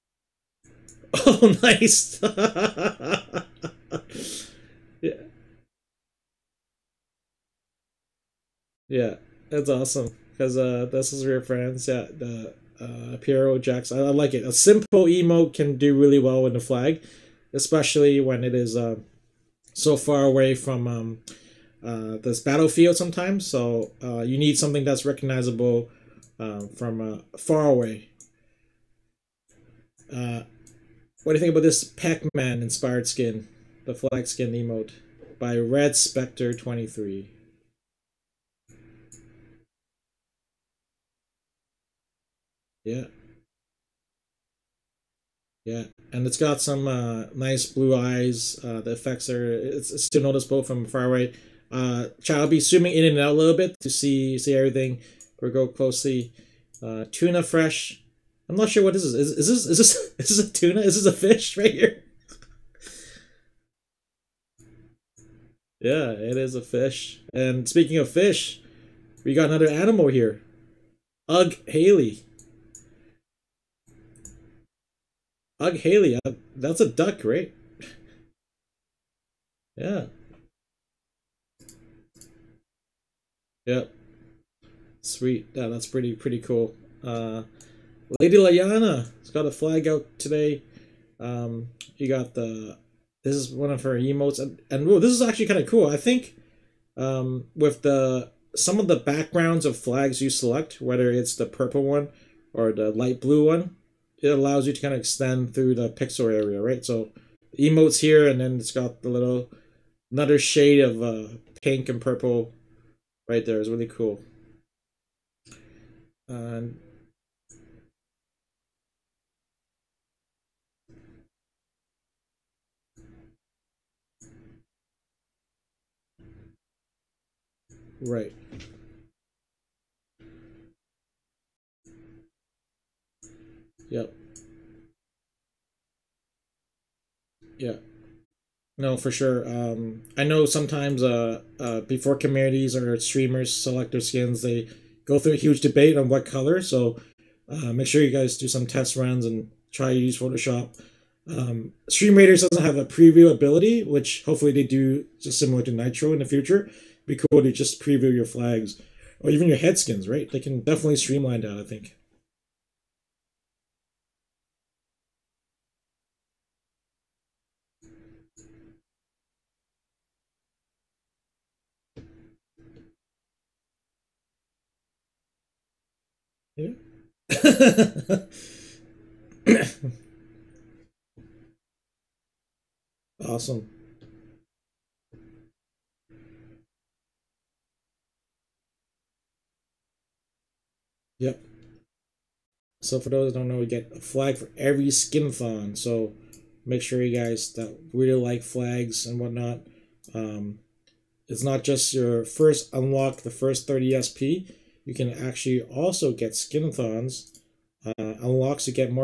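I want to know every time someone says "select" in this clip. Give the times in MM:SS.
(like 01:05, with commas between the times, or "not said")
01:40, 02:23.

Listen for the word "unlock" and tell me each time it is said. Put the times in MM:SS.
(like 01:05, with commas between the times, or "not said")
03:22, 03:28.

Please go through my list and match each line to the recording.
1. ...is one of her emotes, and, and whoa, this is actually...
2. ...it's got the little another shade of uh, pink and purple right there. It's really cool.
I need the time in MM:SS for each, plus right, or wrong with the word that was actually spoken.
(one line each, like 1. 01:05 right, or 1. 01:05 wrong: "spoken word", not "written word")
1. 01:33 right
2. 01:48 right.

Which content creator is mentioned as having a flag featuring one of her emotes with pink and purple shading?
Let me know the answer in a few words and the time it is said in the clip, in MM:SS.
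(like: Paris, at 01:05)
Lady Layana, at 01:28.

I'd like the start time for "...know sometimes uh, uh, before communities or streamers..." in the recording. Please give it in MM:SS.
02:20.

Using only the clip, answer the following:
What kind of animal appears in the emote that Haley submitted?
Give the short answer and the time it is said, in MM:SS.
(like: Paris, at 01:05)
A duck, at 01:16.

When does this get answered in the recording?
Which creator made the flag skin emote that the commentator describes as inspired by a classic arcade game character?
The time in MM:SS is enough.
00:35.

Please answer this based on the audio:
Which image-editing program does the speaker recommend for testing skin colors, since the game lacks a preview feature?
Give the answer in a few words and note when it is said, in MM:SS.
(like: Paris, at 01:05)
Photoshop, at 02:30.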